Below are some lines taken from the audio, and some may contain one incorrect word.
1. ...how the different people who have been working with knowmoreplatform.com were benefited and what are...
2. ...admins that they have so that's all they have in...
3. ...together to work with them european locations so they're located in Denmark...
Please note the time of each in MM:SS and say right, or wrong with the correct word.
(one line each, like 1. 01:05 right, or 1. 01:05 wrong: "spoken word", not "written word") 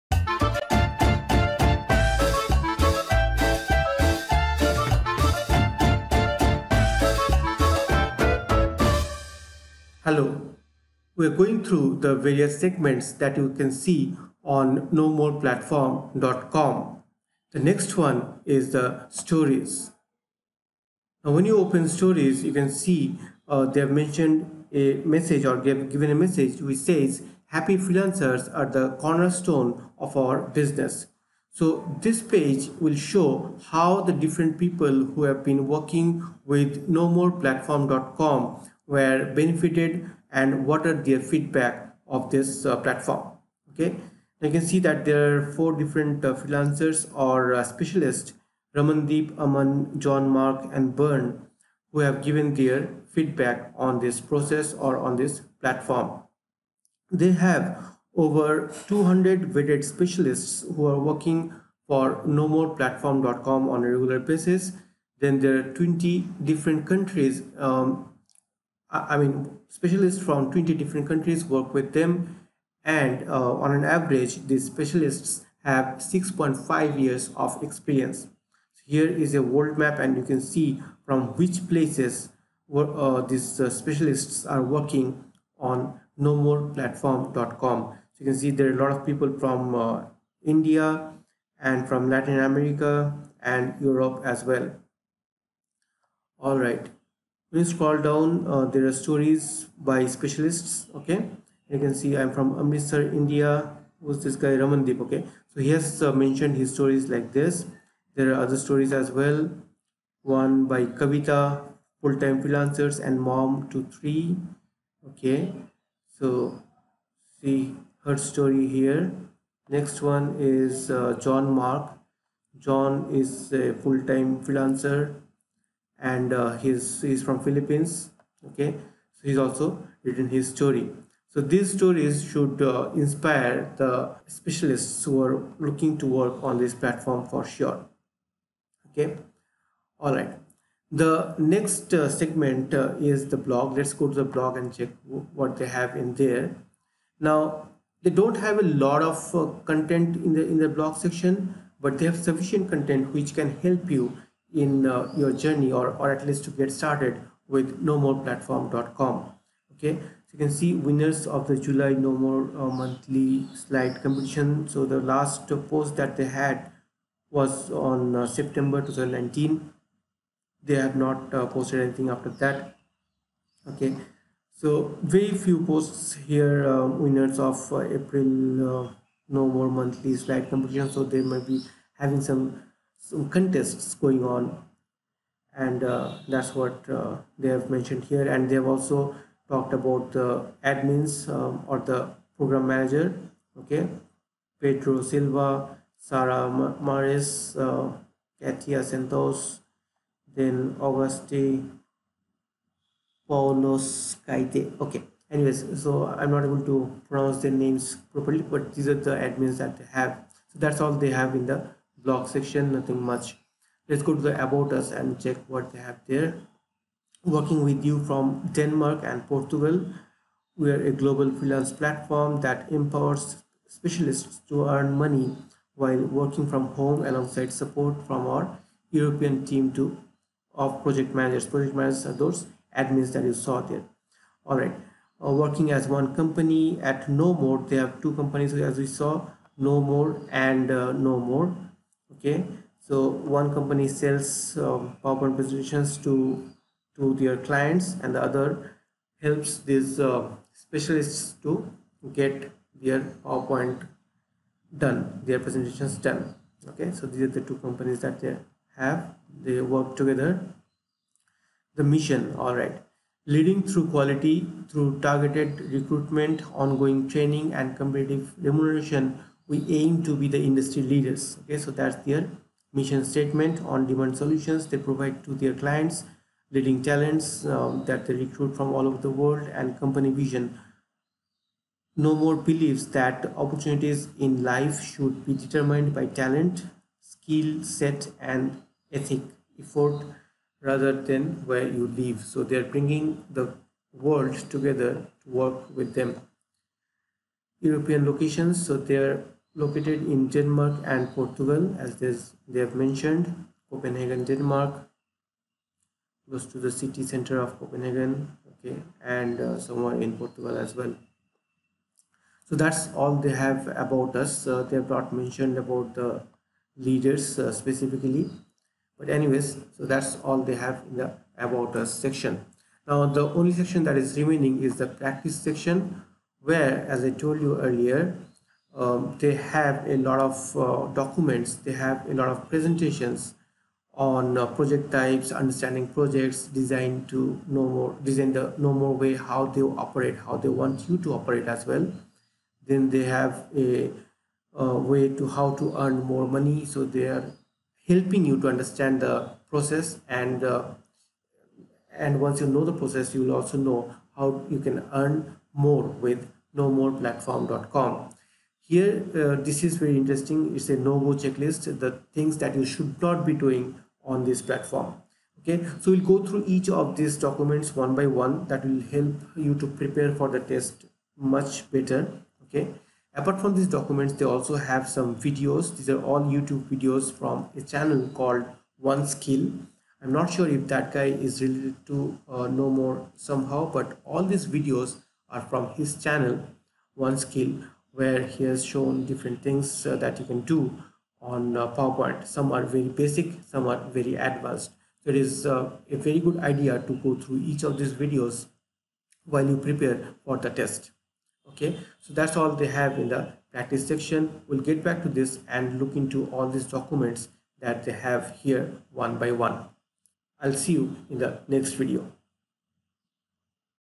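1. 00:33 right
2. 03:29 right
3. 04:54 right.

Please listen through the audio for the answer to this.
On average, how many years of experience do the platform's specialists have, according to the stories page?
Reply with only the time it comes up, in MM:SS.
01:15.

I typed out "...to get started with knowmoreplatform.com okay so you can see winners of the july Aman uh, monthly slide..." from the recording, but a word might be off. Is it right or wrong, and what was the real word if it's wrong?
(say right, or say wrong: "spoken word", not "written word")
wrong: "KnowMore", not "Aman".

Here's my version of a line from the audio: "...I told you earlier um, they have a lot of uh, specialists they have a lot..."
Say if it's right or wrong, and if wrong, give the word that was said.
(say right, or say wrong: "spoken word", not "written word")
wrong: "documents", not "specialists".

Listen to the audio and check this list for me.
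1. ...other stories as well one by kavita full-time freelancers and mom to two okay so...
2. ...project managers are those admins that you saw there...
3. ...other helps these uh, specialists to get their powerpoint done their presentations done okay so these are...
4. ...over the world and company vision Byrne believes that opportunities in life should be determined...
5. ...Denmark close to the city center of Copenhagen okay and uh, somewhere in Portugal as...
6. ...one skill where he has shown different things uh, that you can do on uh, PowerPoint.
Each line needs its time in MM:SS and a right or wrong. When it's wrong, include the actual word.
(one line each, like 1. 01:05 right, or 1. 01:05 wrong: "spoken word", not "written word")
1. 01:48 wrong: "three", not "two"
2. 03:51 right
3. 04:08 right
4. 04:38 wrong: "KnowMore", not "Byrne"
5. 05:04 right
6. 06:27 right.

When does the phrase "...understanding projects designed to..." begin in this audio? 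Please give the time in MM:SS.
05:35.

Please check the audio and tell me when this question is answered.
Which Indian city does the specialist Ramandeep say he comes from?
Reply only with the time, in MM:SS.
01:42.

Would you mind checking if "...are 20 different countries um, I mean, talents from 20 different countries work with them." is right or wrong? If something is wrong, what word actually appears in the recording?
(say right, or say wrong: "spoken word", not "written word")
wrong: "specialists", not "talents".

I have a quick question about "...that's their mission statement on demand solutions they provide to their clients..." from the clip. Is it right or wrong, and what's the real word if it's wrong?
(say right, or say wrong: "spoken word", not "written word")
right.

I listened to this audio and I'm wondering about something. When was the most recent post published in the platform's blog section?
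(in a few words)
September 2019.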